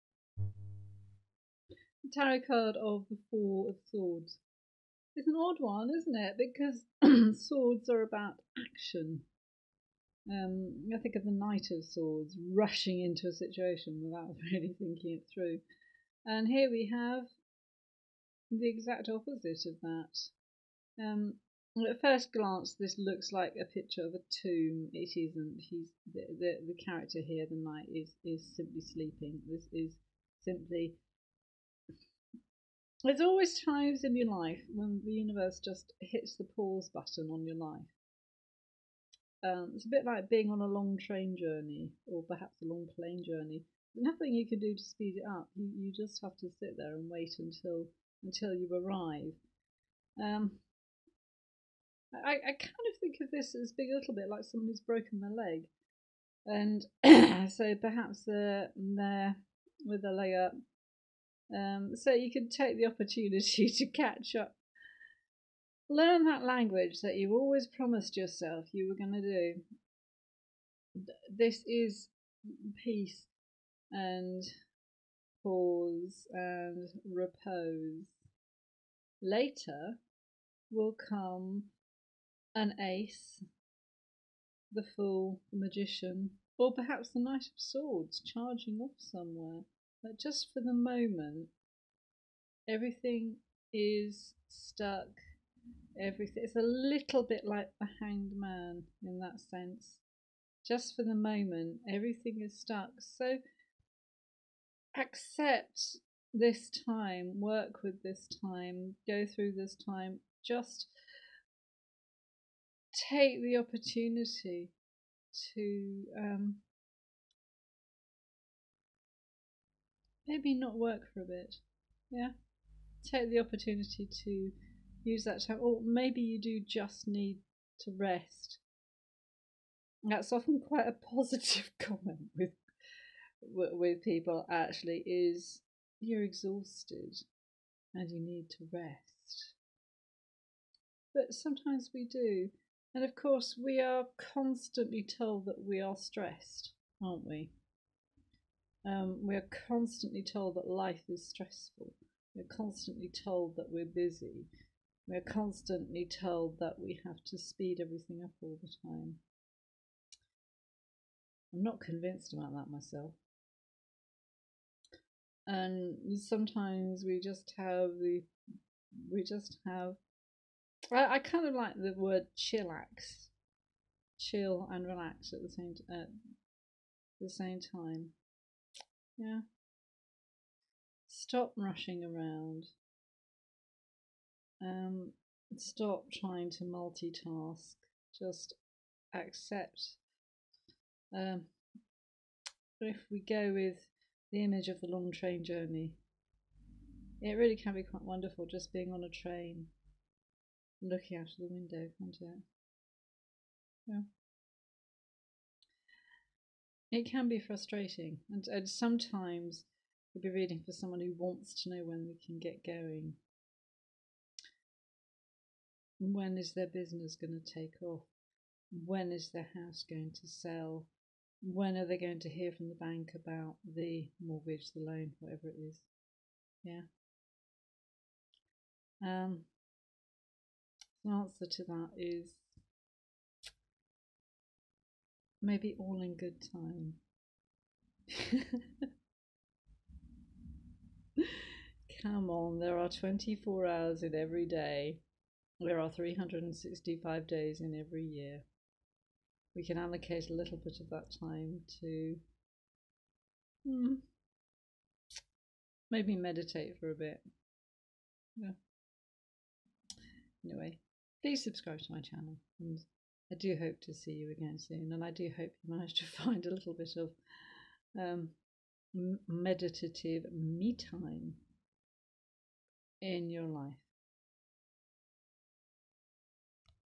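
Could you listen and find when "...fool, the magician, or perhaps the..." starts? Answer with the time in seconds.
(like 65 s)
84 s.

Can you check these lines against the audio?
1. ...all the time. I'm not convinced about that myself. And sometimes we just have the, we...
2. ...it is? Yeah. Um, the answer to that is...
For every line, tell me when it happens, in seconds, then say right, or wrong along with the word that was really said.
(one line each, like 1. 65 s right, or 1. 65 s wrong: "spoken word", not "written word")
1. 158 s right
2. 225 s right.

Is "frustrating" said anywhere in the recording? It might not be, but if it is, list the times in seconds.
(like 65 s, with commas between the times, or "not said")
207 s.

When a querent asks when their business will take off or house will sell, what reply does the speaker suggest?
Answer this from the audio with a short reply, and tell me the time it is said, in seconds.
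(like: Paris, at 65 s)
All in good time, at 235 s.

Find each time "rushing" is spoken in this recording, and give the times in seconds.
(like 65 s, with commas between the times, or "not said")
12 s, 181 s.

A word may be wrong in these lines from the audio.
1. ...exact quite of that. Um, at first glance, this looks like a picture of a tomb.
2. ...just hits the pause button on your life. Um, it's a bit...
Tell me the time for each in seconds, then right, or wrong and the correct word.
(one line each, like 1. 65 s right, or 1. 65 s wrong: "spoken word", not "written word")
1. 18 s wrong: "opposite", not "quite"
2. 35 s right.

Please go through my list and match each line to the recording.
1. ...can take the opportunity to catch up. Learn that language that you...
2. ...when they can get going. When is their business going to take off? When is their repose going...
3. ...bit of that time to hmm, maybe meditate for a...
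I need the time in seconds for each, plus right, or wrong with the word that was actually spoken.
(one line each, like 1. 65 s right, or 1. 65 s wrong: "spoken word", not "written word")
1. 62 s right
2. 211 s wrong: "house", not "repose"
3. 250 s right.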